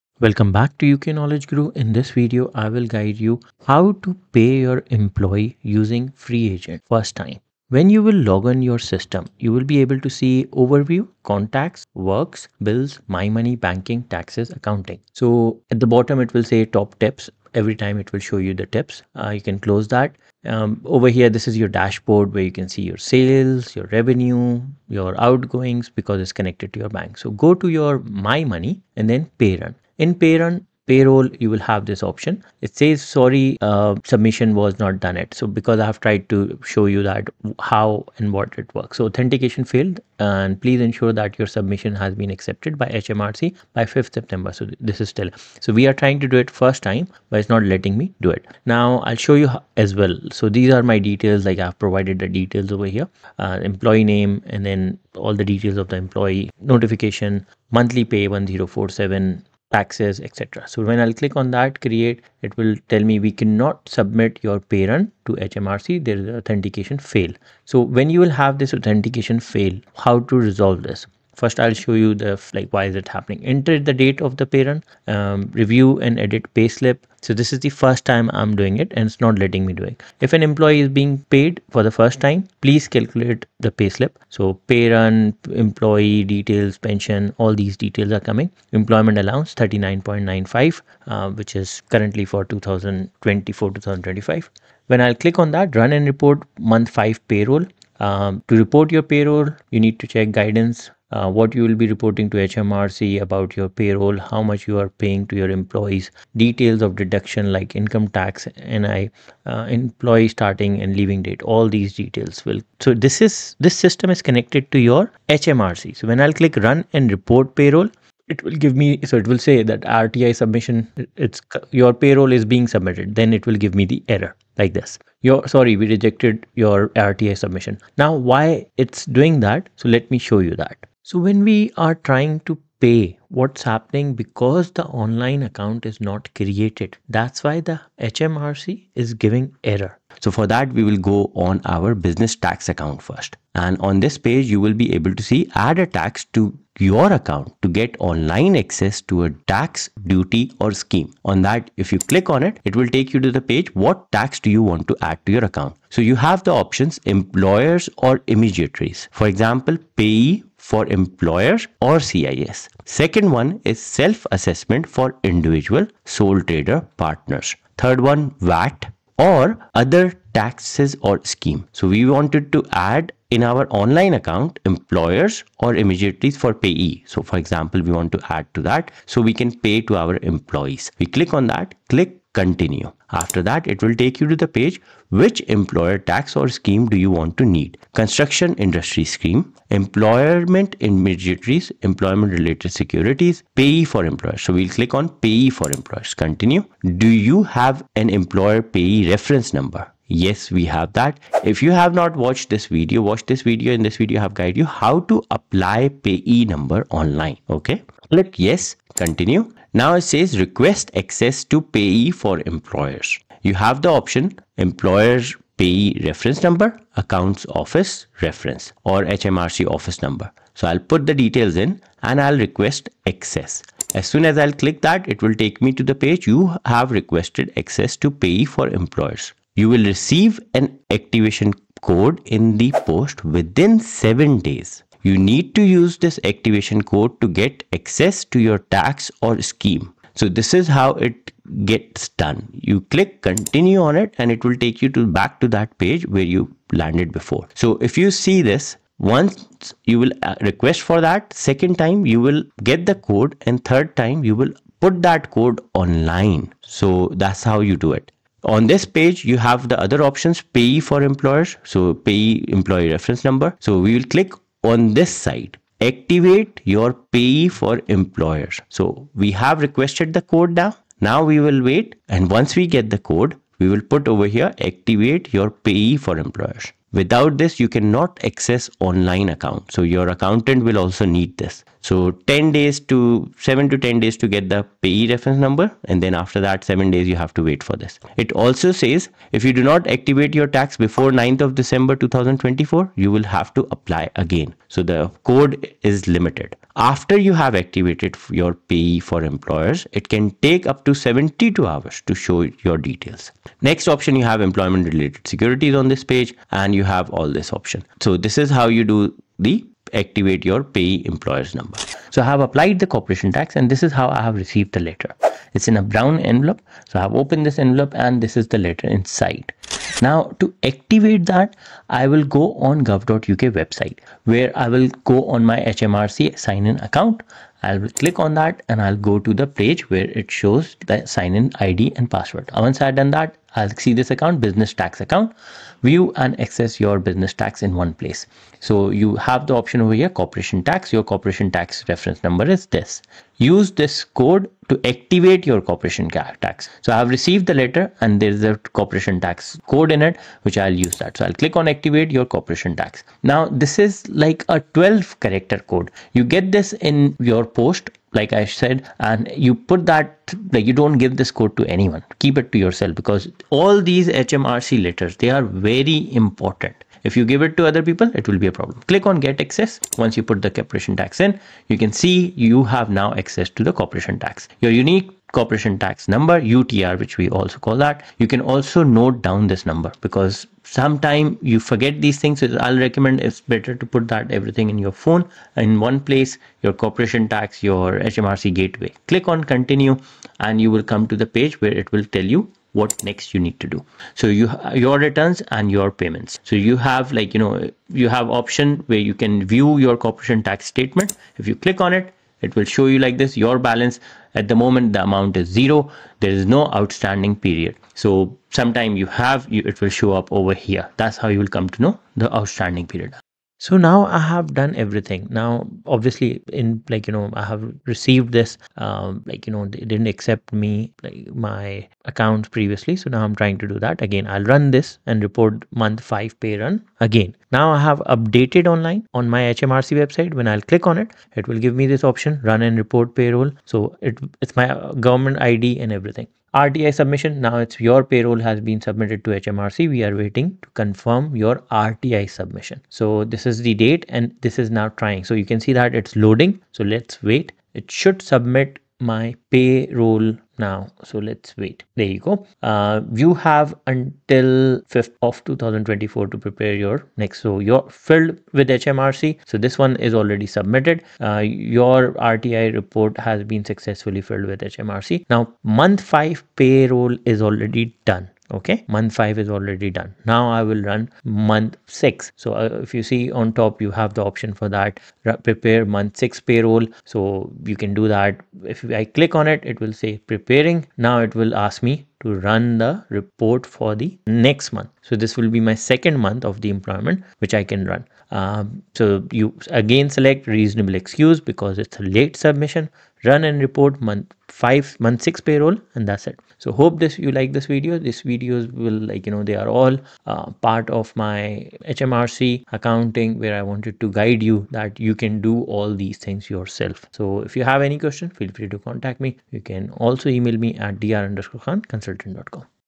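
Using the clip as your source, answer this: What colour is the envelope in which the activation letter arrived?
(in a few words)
Brown.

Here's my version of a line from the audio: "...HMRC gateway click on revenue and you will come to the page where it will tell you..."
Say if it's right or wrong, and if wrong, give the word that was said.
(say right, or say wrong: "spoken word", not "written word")
wrong: "continue", not "revenue".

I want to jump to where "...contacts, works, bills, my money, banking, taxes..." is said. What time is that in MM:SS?
00:11.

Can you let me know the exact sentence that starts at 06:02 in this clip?
Keep it to yourself because all these HMRC letters they are very important.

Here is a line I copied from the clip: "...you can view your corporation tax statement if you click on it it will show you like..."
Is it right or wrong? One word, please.
right.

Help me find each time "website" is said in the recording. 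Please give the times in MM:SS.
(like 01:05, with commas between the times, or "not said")
05:23, 07:10.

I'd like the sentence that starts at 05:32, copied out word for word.
Once I've done that, I'll see this account, business tax account, view and access your business tax in one place.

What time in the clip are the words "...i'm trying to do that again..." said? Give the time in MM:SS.
07:03.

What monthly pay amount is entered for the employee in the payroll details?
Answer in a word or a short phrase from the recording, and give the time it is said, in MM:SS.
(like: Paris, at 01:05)
1047, at 00:57.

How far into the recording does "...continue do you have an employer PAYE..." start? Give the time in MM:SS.
03:16.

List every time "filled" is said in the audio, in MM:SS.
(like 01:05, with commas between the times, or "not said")
07:38, 07:44.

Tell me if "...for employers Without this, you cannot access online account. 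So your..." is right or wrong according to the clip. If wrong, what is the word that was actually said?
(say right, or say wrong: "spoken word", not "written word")
right.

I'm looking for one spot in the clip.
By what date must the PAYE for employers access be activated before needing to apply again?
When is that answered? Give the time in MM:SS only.
04:51.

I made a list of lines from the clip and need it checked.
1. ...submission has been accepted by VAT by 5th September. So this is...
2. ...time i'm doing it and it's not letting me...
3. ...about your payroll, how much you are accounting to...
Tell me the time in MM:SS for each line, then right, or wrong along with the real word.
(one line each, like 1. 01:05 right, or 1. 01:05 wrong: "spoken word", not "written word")
1. 00:41 wrong: "HMRC", not "VAT"
2. 01:18 right
3. 01:43 wrong: "paying", not "accounting".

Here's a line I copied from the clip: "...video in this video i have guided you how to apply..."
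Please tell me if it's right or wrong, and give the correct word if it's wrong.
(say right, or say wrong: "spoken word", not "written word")
right.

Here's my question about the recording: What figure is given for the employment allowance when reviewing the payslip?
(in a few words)
39.95.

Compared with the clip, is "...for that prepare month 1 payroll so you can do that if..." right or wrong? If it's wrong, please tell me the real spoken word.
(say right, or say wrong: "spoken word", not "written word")
wrong: "6", not "1".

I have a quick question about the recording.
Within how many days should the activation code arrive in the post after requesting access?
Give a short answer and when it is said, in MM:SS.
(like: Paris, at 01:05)
7, at 03:53.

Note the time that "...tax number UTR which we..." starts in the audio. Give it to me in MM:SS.
06:15.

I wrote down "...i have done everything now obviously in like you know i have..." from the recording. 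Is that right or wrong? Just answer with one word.
right.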